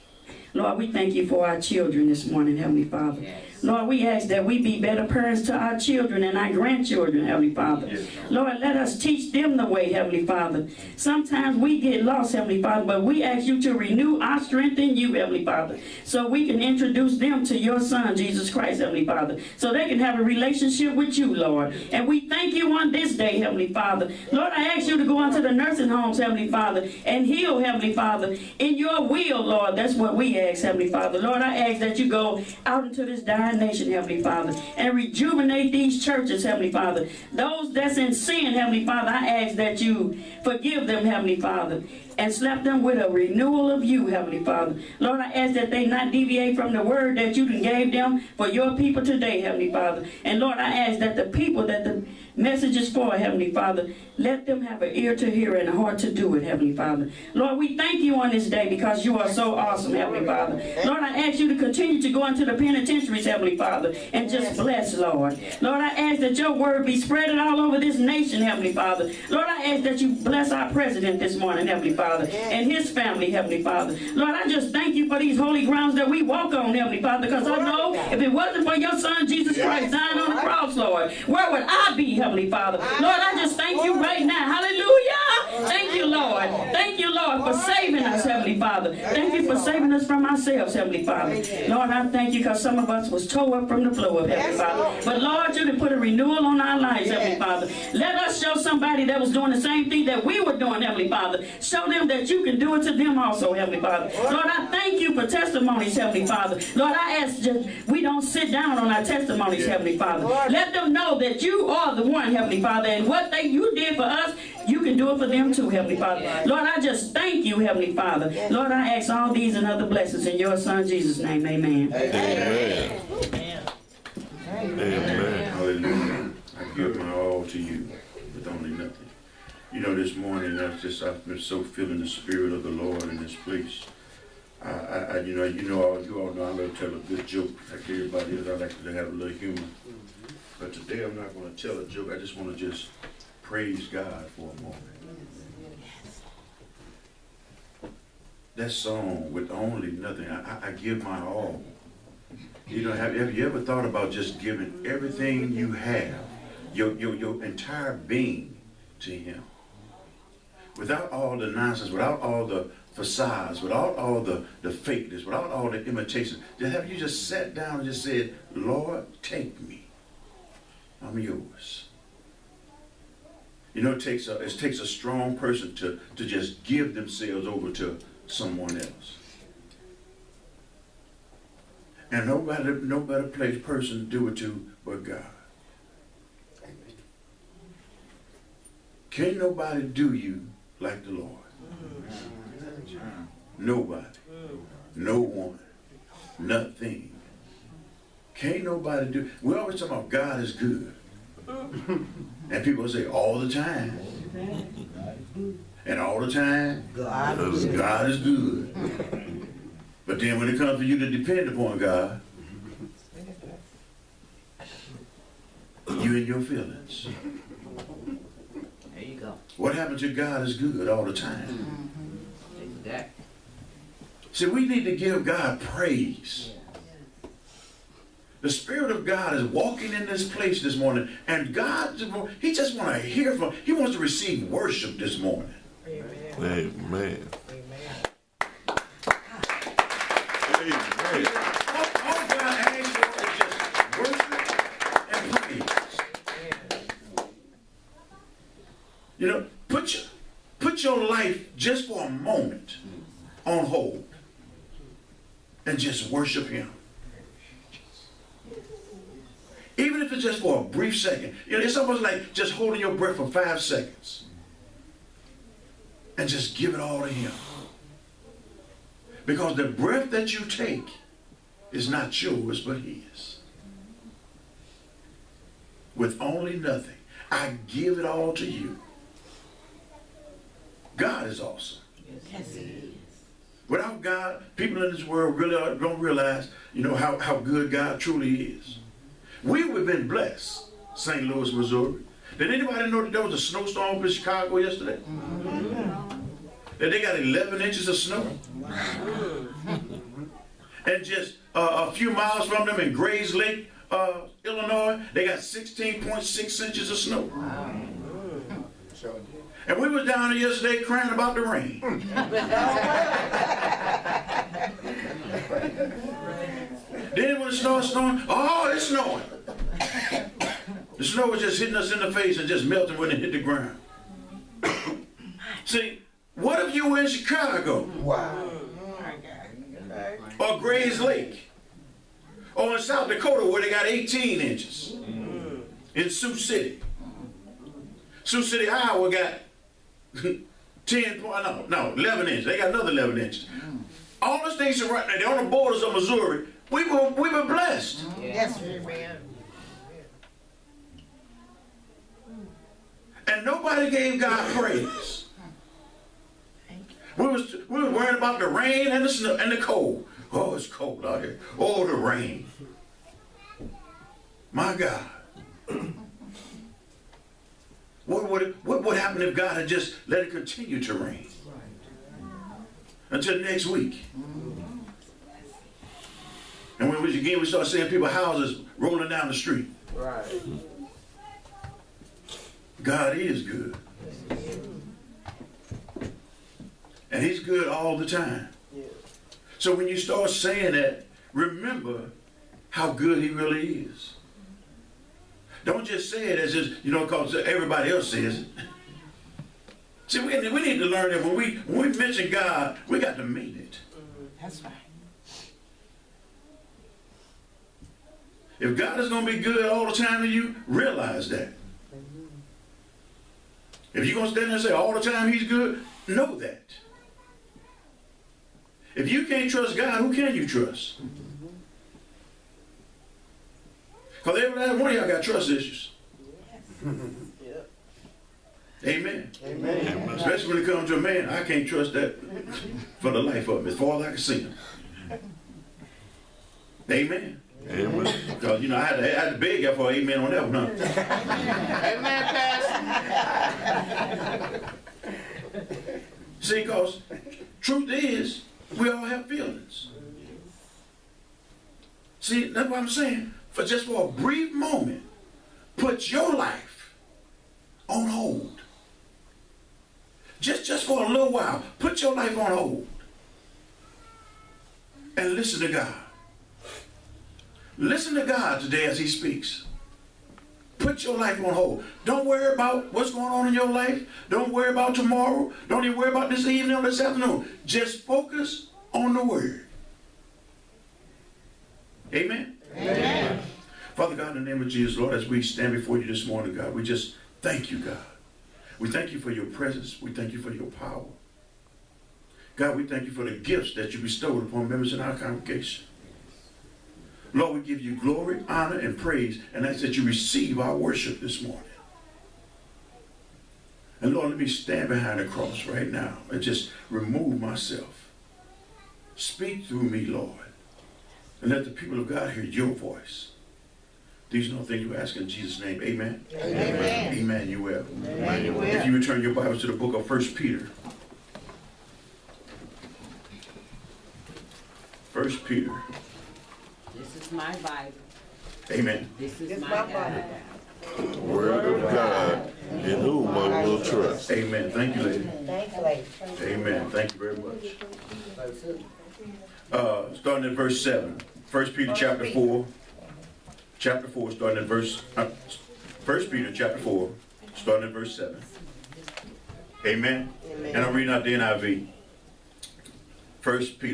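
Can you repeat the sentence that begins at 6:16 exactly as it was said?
And when we again we start seeing people houses rolling down the street.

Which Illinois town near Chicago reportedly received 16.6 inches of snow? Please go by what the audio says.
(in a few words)
Grays Lake.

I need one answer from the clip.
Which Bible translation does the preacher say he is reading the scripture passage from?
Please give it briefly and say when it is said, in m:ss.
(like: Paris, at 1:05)
NIV, at 9:11.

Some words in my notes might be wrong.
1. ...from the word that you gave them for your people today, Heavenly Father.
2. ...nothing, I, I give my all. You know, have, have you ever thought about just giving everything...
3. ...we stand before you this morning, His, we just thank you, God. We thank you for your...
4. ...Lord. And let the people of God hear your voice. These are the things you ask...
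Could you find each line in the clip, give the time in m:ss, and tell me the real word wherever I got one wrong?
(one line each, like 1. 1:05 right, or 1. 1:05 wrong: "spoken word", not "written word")
1. 0:46 right
2. 2:29 right
3. 8:05 wrong: "God", not "His"
4. 8:30 right.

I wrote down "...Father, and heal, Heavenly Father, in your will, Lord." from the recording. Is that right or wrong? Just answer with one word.
right.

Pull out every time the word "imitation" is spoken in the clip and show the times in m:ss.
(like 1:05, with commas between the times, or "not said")
2:45.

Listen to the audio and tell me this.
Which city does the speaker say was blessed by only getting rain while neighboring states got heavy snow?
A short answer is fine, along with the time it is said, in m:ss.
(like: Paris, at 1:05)
St. Louis, at 4:50.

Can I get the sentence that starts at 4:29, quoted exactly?
Because the breath that you take is not yours, but His.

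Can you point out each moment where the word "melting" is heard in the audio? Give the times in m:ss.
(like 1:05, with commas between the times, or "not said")
5:22.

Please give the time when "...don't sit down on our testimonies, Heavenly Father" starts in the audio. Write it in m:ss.
1:48.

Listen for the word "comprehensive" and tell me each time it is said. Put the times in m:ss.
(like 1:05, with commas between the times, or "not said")
not said.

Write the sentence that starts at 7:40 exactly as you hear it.
Just, just for a little while, put your life on hold.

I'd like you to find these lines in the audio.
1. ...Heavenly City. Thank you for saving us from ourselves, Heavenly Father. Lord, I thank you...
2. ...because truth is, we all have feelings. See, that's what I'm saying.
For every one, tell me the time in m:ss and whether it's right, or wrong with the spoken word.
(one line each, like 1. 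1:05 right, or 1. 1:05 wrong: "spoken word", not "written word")
1. 1:28 wrong: "Father", not "City"
2. 7:26 right.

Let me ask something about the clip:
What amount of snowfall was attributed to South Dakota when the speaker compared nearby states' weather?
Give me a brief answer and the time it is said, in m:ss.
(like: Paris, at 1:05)
18 inches, at 5:33.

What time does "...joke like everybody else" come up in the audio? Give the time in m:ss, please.
2:17.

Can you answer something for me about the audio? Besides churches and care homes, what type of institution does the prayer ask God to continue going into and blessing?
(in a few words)
penitentiaries.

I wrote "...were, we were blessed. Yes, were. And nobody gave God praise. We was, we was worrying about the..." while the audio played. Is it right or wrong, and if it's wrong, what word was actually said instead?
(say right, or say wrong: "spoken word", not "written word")
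right.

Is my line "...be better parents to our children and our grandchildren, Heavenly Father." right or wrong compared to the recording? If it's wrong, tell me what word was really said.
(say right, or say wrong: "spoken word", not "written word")
right.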